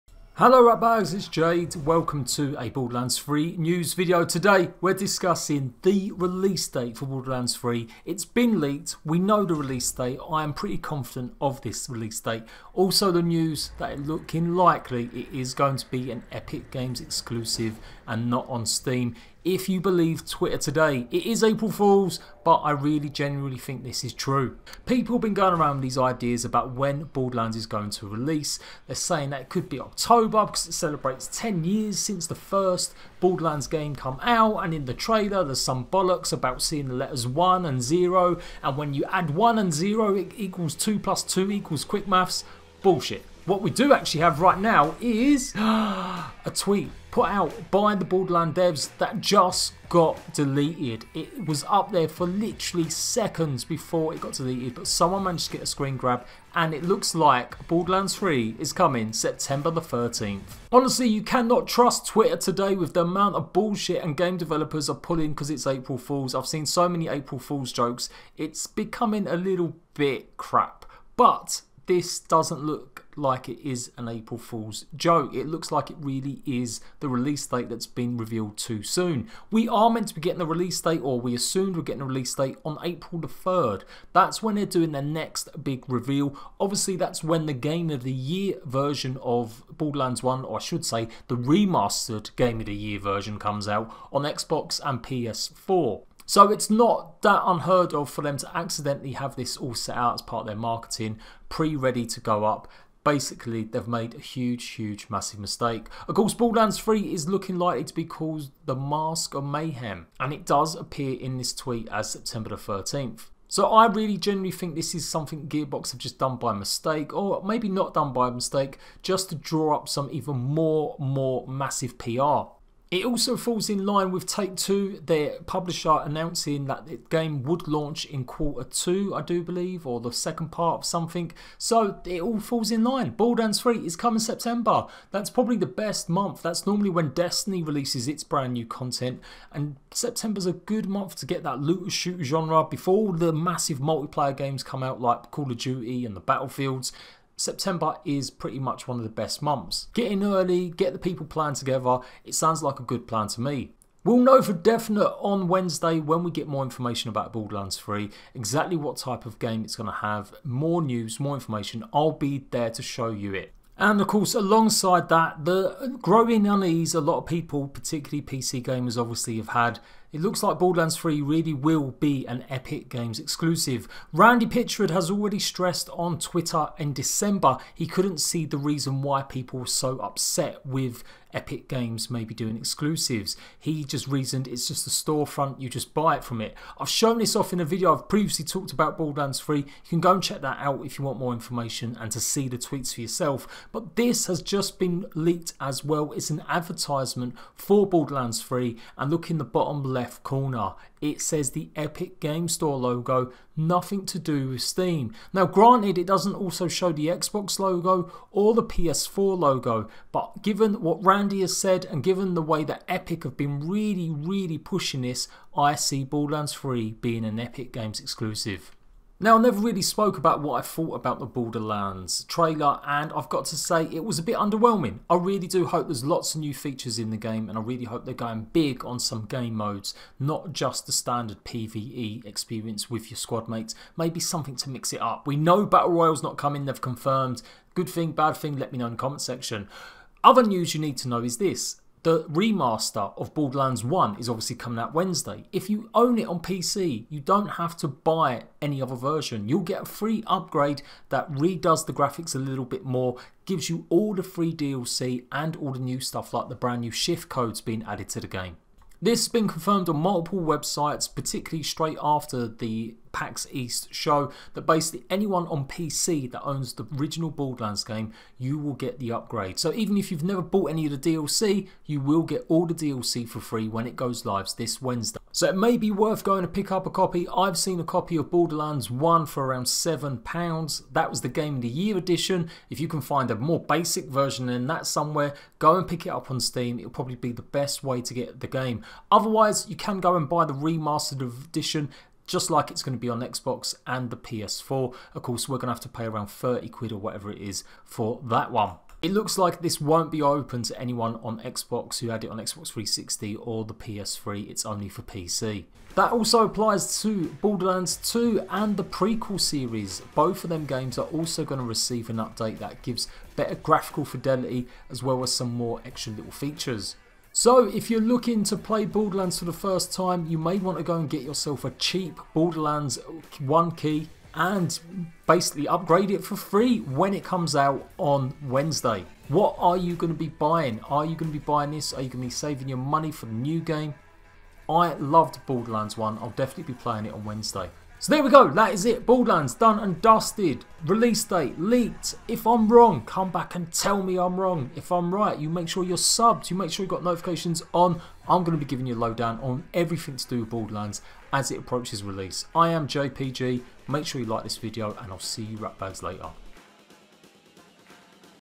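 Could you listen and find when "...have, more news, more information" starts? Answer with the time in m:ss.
2:39.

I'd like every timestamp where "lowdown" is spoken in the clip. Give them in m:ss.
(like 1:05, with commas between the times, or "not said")
5:48.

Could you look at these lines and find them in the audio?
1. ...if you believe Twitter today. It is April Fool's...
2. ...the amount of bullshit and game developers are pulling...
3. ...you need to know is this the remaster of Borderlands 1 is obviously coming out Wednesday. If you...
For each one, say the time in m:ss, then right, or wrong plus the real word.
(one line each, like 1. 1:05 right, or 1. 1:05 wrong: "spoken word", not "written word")
1. 0:19 right
2. 1:02 right
3. 4:00 right.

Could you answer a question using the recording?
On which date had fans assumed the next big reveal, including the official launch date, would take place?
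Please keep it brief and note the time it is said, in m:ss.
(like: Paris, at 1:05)
April 3rd, at 1:22.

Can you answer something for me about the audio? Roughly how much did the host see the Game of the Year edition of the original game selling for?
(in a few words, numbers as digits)
£7.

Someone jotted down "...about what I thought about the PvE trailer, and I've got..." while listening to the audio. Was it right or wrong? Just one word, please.
wrong.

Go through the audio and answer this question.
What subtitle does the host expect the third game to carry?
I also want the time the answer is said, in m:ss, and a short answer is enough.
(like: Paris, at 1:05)
The Mask of Mayhem, at 1:48.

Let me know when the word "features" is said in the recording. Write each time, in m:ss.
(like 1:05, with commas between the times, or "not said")
3:46, 5:16.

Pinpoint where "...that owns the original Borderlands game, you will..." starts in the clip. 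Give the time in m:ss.
4:26.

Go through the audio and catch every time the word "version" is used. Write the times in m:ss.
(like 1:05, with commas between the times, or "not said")
1:28, 1:32, 4:08, 4:44.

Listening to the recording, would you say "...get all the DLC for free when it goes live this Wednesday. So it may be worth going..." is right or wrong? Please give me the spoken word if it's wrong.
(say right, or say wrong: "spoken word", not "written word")
right.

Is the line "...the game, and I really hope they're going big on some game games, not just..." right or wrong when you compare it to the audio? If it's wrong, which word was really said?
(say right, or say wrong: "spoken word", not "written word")
wrong: "modes", not "games".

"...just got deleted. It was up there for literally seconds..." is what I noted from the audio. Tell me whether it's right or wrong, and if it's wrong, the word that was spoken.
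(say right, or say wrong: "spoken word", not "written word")
right.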